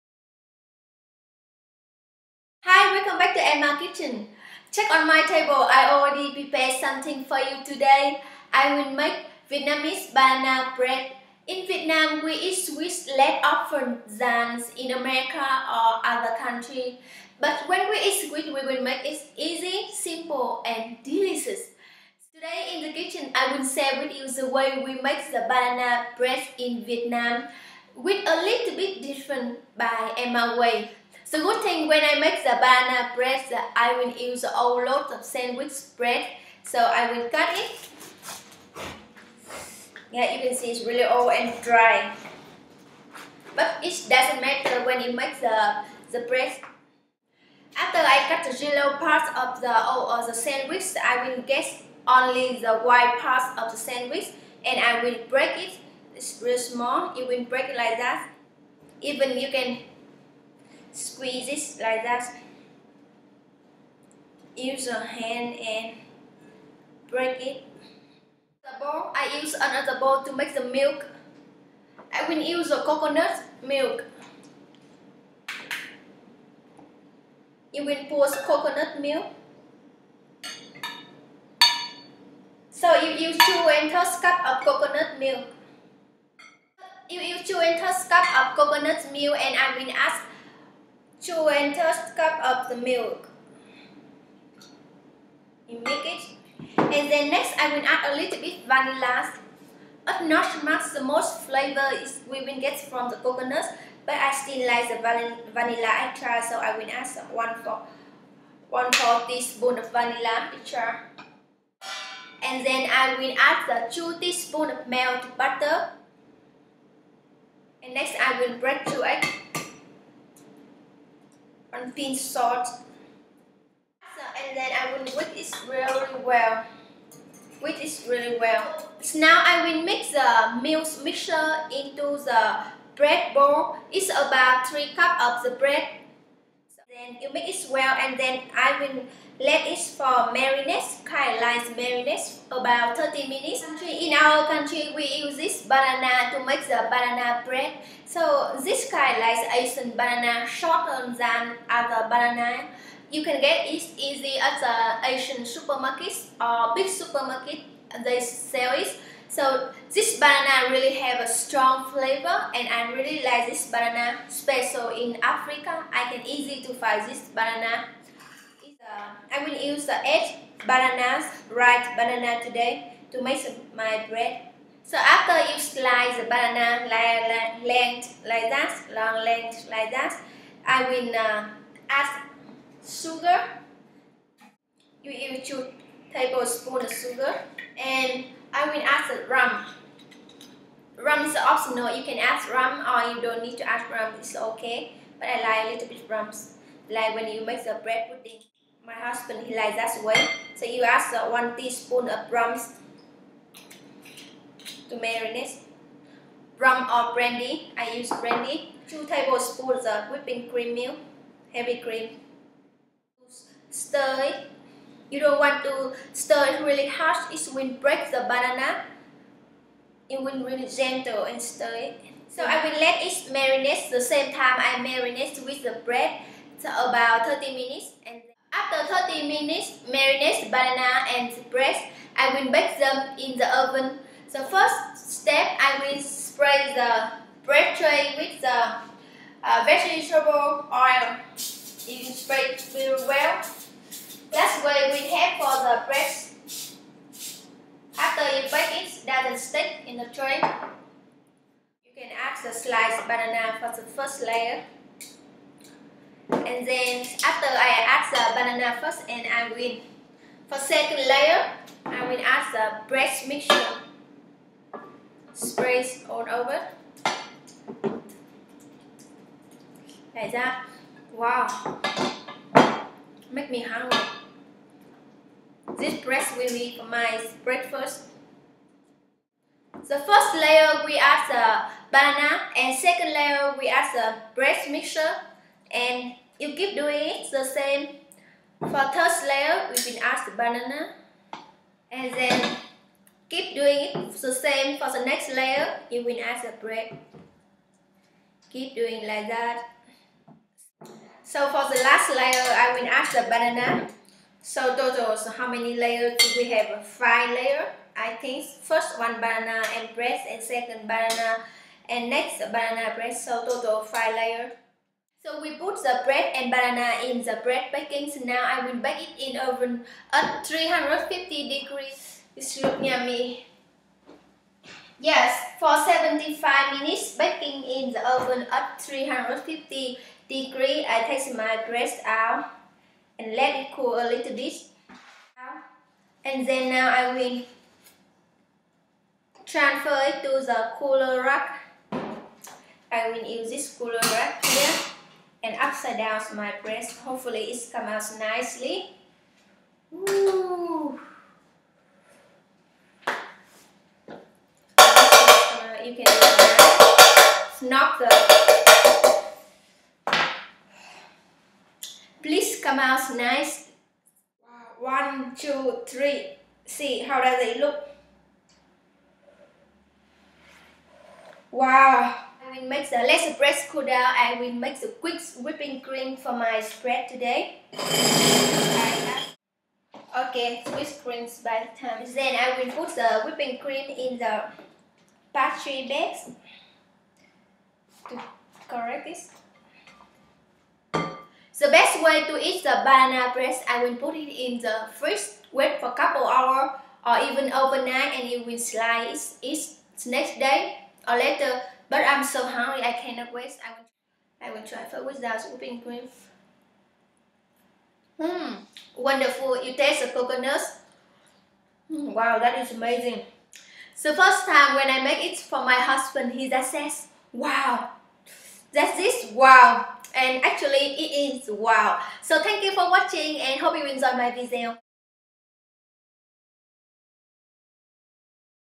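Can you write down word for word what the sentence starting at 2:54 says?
So after you slice the banana like, length like that, long length like that, I will uh, add sugar.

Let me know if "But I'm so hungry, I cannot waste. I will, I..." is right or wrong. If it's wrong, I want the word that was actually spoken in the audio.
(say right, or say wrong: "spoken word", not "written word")
right.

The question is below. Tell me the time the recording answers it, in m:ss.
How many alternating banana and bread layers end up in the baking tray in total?
5:13.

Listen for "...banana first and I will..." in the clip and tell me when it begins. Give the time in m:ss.
4:18.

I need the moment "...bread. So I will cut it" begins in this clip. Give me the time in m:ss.
0:35.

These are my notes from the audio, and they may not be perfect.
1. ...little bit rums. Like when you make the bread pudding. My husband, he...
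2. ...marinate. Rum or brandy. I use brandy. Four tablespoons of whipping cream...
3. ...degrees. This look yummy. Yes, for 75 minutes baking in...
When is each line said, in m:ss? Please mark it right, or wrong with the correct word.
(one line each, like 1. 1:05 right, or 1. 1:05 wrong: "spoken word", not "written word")
1. 3:15 right
2. 3:24 wrong: "Two", not "Four"
3. 5:21 right.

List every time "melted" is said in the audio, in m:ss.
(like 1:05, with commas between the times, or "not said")
1:54.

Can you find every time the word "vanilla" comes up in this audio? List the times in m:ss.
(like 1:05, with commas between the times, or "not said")
1:38, 1:45, 1:49.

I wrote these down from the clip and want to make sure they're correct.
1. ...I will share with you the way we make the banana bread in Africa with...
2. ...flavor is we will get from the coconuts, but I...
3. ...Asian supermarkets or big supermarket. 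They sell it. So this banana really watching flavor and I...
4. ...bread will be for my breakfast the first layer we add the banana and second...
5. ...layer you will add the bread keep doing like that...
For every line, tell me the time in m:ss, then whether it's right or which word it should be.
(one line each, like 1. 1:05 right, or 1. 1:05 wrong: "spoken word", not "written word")
1. 0:23 wrong: "Vietnam", not "Africa"
2. 1:41 right
3. 2:35 wrong: "strong", not "watching"
4. 4:36 right
5. 4:55 right.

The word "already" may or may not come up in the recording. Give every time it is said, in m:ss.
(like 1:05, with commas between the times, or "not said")
0:05.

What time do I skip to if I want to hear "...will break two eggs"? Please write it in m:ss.
1:58.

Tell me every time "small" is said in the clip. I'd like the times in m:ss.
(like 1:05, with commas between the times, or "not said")
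0:56.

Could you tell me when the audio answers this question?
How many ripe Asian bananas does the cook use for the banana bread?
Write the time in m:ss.
2:50.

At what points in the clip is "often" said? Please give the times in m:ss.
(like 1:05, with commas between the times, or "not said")
0:13.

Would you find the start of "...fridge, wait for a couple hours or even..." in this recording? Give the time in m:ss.
6:34.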